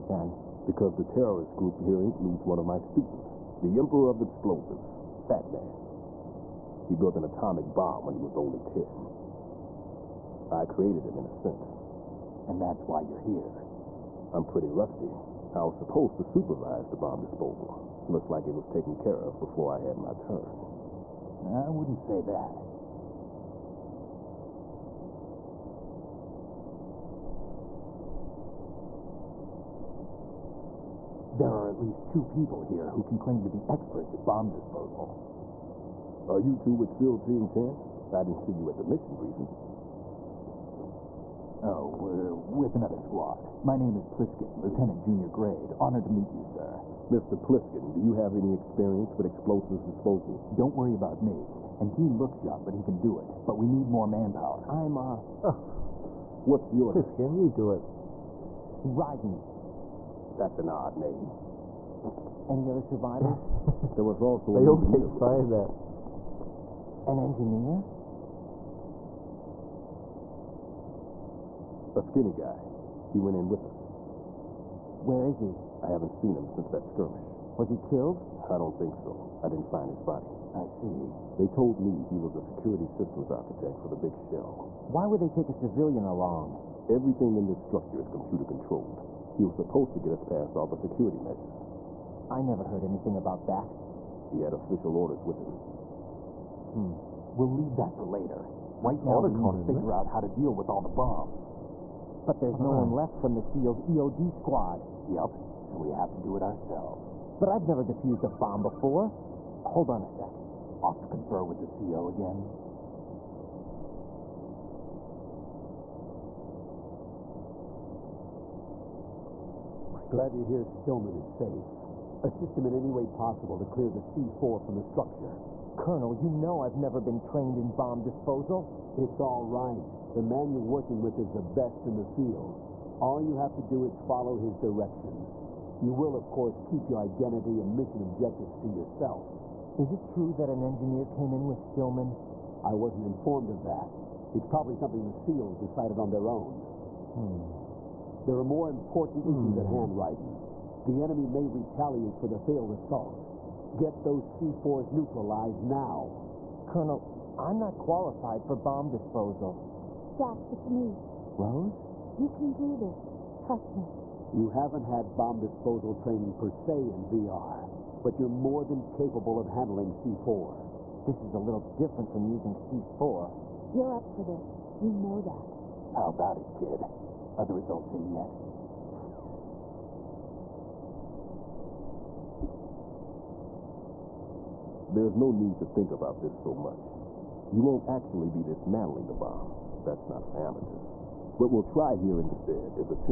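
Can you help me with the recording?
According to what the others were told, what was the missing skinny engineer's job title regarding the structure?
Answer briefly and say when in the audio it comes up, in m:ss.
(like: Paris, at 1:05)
security systems architect, at 1:22.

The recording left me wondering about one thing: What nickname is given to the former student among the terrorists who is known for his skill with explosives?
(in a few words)
Emperor of Explosives.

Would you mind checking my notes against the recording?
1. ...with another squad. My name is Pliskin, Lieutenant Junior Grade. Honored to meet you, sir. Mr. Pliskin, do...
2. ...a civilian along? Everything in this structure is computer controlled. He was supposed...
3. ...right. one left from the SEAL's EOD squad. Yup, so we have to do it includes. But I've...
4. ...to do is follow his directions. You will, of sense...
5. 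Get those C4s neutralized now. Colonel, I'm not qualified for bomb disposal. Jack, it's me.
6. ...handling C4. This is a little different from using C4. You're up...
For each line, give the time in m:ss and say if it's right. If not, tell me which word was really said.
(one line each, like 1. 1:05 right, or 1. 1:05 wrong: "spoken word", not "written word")
1. 0:42 right
2. 1:25 right
3. 1:42 wrong: "ourselves", not "includes"
4. 2:13 wrong: "course", not "sense"
5. 2:33 right
6. 2:49 right.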